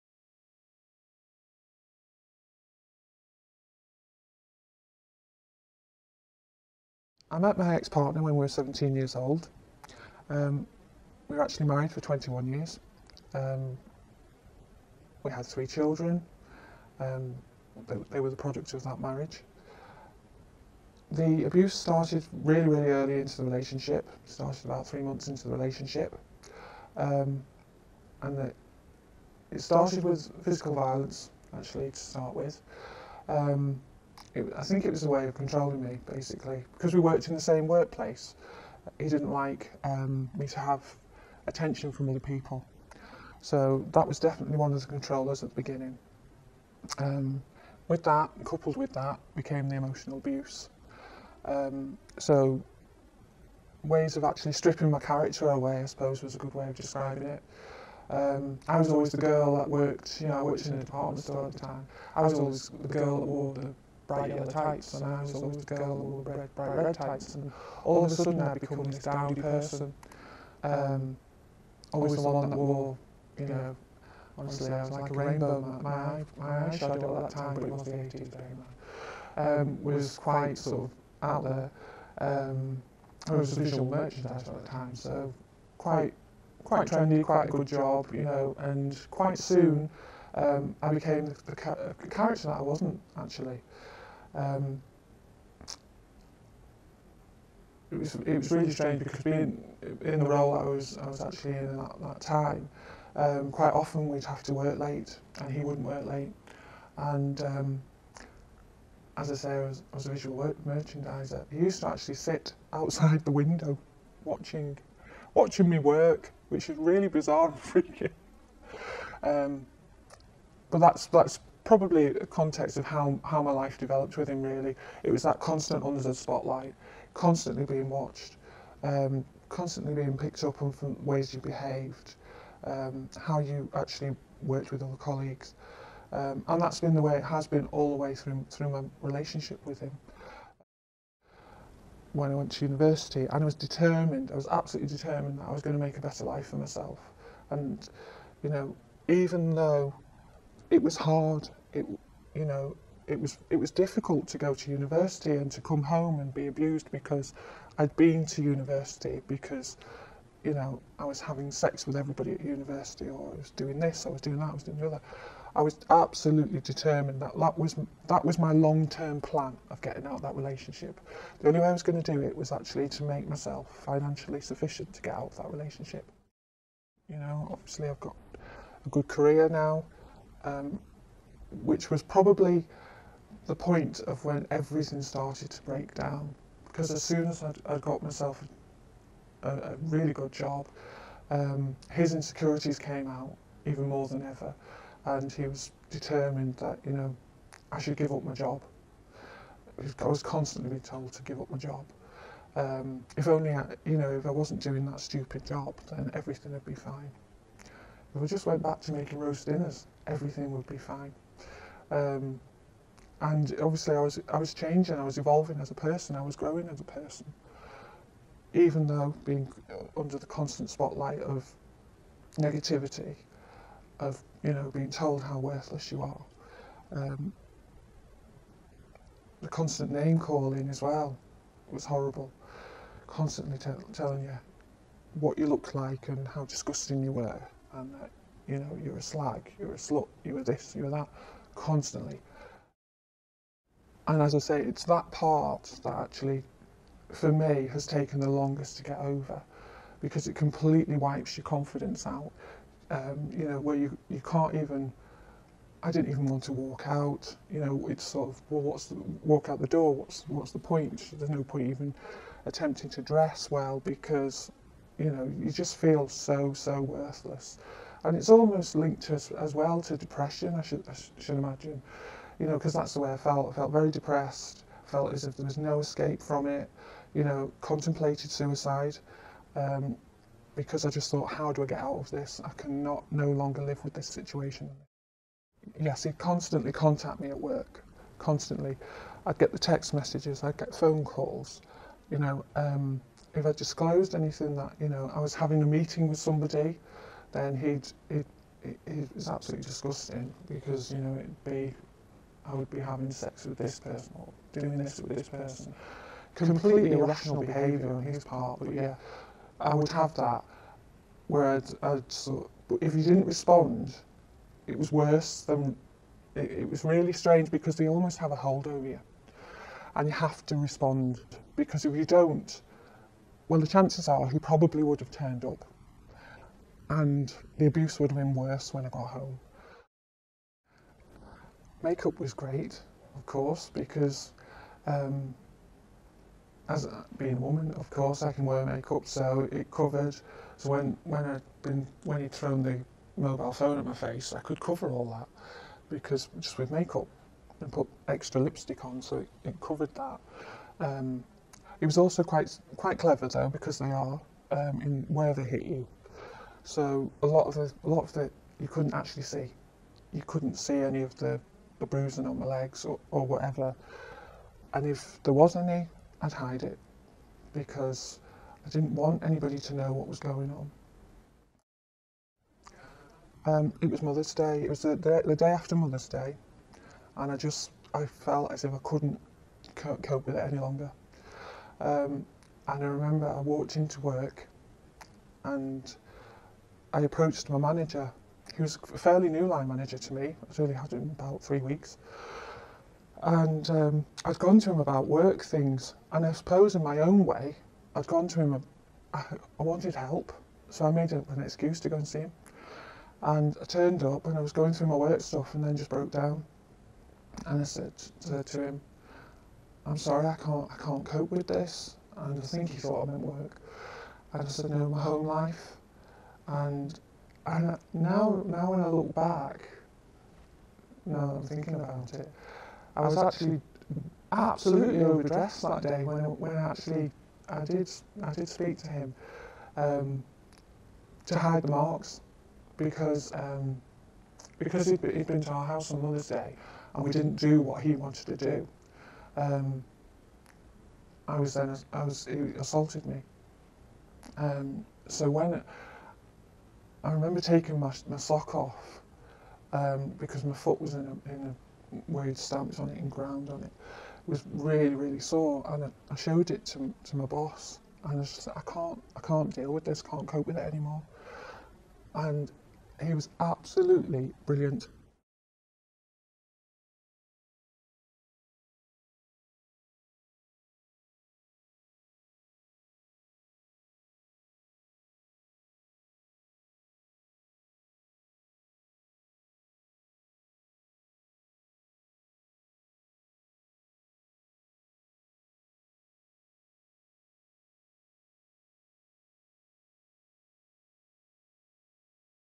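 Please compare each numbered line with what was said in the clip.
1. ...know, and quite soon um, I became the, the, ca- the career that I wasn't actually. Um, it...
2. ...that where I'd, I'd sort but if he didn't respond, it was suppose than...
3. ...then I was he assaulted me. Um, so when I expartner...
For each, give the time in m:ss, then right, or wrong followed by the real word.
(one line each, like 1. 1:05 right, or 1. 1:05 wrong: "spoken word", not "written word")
1. 1:28 wrong: "character", not "career"
2. 5:10 wrong: "worse", not "suppose"
3. 7:21 wrong: "remember", not "expartner".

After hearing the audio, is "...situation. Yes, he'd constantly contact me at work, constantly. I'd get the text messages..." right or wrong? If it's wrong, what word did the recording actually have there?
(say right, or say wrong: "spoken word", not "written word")
right.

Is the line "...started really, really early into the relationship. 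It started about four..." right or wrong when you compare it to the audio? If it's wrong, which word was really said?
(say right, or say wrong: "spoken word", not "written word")
wrong: "three", not "four".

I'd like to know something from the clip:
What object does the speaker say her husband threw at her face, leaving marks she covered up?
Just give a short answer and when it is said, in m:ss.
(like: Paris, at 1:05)
mobile phone, at 5:43.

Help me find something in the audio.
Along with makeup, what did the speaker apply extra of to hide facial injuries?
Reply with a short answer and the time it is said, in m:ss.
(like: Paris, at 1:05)
lipstick, at 5:48.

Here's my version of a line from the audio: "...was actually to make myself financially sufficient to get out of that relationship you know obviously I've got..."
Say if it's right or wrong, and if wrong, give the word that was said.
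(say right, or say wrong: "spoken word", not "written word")
right.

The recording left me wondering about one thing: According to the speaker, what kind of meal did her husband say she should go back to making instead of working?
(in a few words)
roast dinners.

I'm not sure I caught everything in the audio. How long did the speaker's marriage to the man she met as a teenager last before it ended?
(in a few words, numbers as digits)
21 years.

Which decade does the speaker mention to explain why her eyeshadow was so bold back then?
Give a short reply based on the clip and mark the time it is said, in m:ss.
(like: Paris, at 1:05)
the 80s, at 1:17.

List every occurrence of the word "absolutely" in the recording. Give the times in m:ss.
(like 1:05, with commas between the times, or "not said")
2:24, 2:45, 4:59, 7:04, 7:43.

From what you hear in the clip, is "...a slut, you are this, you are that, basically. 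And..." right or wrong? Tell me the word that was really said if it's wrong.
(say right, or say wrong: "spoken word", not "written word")
wrong: "constantly", not "basically".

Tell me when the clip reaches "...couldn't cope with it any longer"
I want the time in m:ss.
6:18.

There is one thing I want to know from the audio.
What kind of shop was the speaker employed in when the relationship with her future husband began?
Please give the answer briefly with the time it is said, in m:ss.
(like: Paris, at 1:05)
department store, at 1:00.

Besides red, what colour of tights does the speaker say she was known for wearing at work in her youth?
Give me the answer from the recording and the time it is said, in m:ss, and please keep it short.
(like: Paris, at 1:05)
yellow, at 1:04.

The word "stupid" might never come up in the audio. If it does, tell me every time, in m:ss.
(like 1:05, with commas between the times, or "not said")
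3:24.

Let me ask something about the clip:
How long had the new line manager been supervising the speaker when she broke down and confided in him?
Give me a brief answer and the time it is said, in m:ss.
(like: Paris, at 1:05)
3 weeks, at 6:31.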